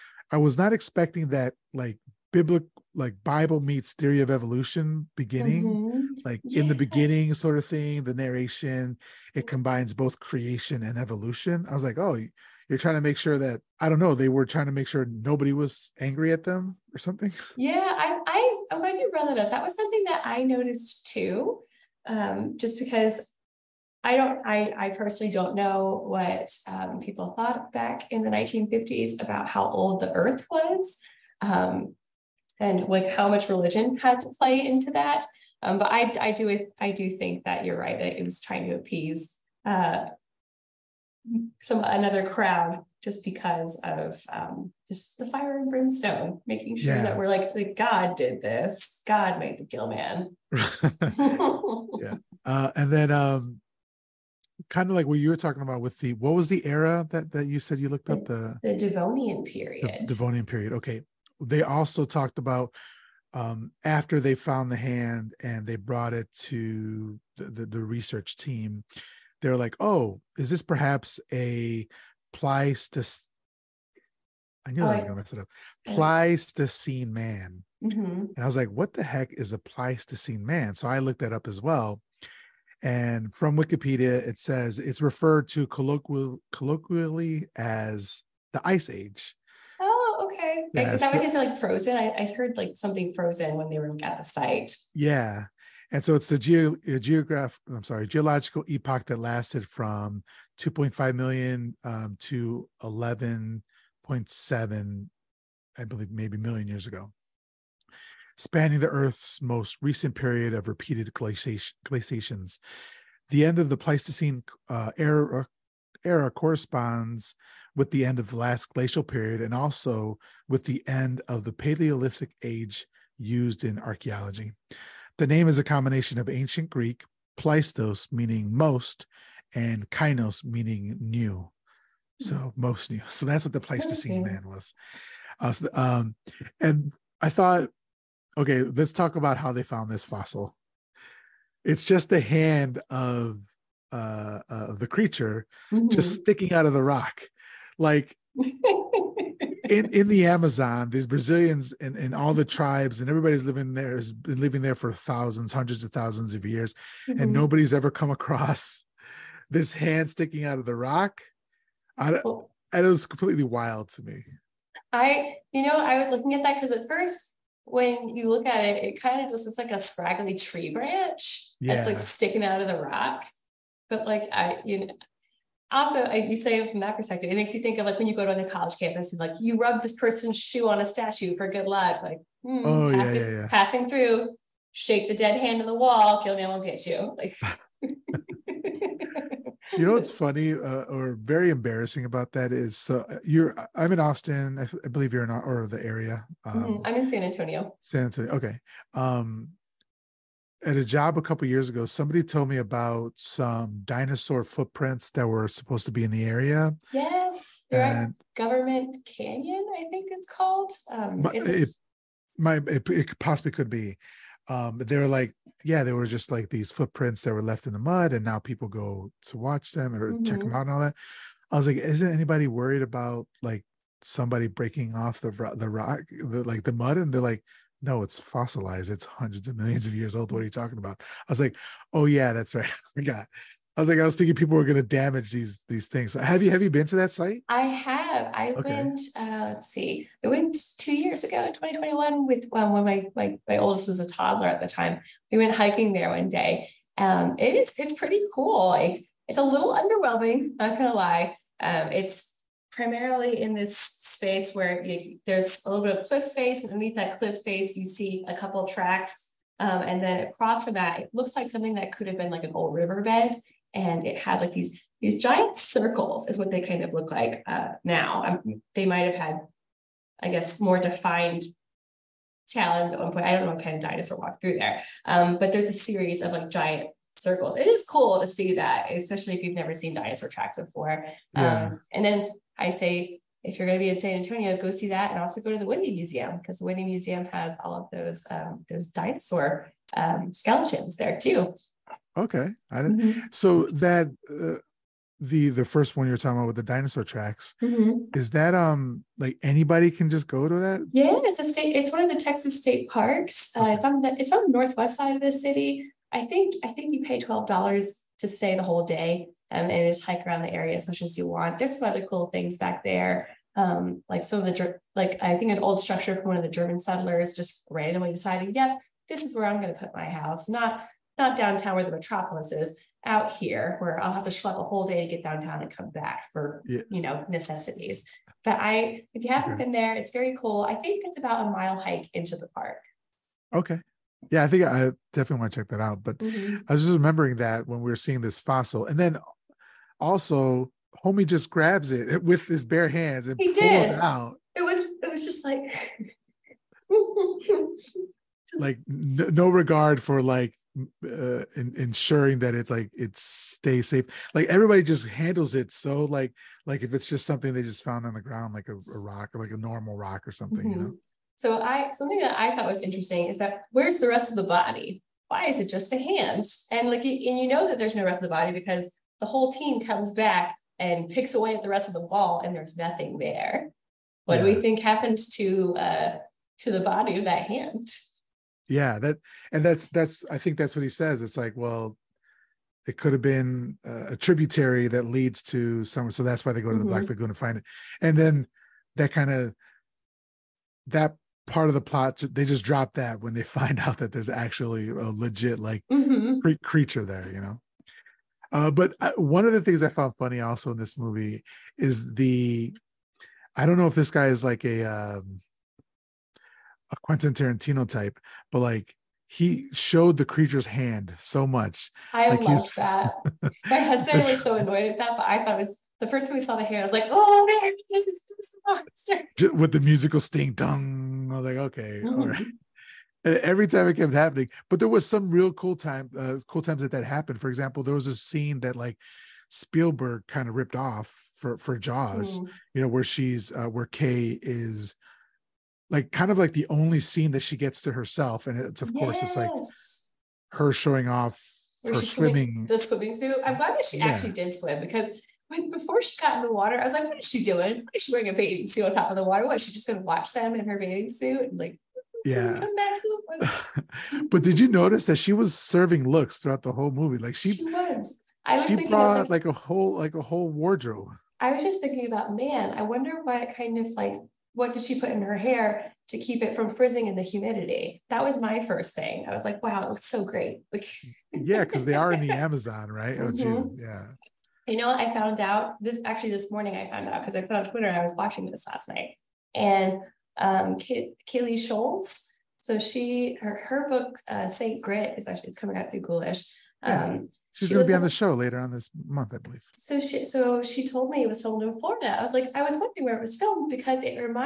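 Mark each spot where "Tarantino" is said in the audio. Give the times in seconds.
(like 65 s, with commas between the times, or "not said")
407 s.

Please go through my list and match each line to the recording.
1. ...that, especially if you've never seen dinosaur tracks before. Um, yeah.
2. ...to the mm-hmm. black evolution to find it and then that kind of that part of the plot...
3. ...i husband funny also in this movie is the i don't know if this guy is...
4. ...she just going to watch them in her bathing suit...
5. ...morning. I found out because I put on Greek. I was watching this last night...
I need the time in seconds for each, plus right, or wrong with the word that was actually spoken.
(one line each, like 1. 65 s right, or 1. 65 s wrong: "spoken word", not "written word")
1. 278 s right
2. 386 s wrong: "lagoon", not "evolution"
3. 399 s wrong: "found", not "husband"
4. 449 s right
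5. 476 s wrong: "Twitter", not "Greek".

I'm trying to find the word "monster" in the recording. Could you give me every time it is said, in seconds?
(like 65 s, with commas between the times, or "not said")
419 s.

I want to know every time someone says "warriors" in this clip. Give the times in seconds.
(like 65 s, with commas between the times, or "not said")
not said.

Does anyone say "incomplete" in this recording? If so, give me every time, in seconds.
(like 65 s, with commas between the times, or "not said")
not said.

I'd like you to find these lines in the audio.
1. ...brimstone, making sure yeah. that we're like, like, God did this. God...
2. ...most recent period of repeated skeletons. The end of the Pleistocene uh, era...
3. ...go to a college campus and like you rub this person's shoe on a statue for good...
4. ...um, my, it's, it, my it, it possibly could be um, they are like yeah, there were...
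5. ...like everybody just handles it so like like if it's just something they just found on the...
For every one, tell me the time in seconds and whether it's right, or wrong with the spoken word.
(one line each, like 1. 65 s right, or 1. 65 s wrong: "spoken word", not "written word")
1. 45 s right
2. 109 s wrong: "glaciations", not "skeletons"
3. 178 s right
4. 210 s right
5. 354 s right.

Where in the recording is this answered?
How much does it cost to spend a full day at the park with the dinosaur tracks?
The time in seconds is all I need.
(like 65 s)
307 s.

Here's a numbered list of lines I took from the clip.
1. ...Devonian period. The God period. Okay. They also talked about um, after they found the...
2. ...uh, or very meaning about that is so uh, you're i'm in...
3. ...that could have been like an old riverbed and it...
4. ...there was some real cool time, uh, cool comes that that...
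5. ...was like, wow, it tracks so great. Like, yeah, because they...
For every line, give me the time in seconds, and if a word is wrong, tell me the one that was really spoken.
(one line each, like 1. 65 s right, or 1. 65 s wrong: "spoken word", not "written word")
1. 58 s wrong: "Devonian", not "God"
2. 190 s wrong: "embarrassing", not "meaning"
3. 261 s right
4. 424 s wrong: "times", not "comes"
5. 469 s wrong: "looks", not "tracks".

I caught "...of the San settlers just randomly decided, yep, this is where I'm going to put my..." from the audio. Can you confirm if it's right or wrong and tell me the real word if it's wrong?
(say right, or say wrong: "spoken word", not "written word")
wrong: "German", not "San".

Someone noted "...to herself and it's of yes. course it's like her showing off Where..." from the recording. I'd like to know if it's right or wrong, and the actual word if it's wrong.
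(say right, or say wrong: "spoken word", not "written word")
right.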